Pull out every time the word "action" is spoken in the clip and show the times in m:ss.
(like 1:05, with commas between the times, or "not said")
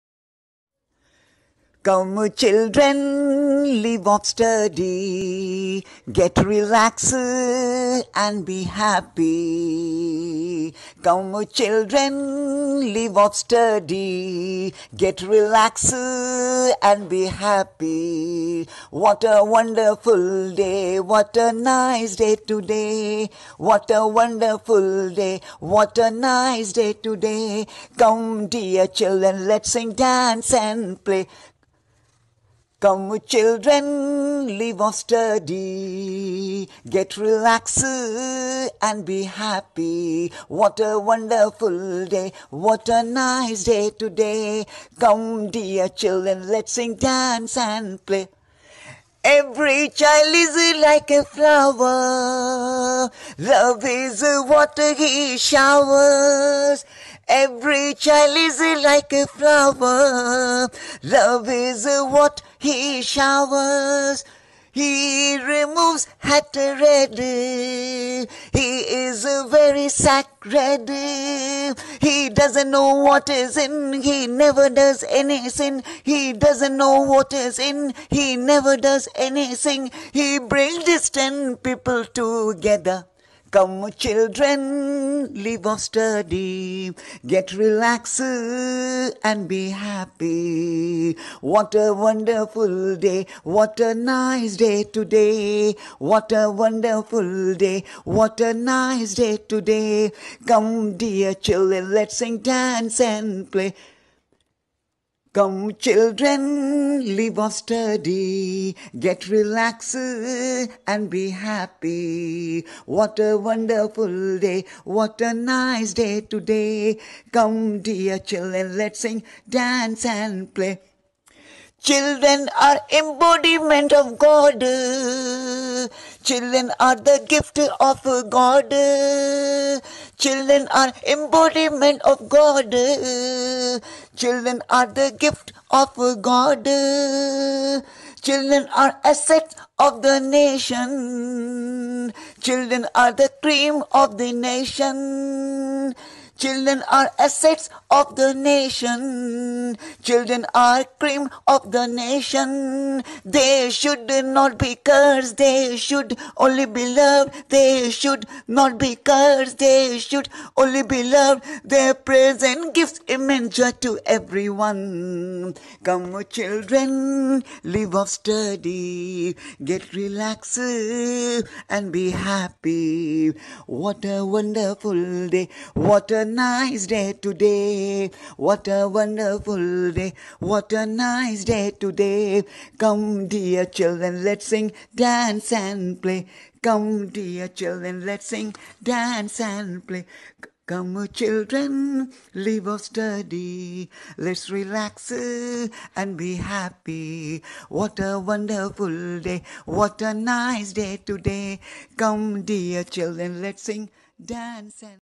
not said.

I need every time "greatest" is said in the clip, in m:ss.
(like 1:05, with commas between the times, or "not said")
not said.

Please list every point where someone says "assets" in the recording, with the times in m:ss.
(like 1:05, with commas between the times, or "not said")
2:19, 2:27.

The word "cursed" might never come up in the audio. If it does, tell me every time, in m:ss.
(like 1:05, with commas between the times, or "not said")
2:34, 2:38.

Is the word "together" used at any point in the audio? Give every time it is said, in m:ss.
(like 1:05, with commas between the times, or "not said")
1:22.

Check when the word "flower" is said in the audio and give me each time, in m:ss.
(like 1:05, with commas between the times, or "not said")
0:51, 0:59.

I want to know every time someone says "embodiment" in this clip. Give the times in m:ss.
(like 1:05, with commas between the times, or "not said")
2:02, 2:11.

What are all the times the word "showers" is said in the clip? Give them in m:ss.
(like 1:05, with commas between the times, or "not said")
0:55, 1:03.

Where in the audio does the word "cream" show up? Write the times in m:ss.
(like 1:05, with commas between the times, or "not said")
2:23, 2:30.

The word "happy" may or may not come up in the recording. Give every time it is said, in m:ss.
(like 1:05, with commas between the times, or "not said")
0:08, 0:17, 0:39, 1:29, 1:51, 2:52, 3:16.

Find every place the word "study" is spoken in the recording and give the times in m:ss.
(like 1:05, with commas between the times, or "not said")
0:04, 0:13, 0:34, 1:25, 1:47, 2:48, 3:12.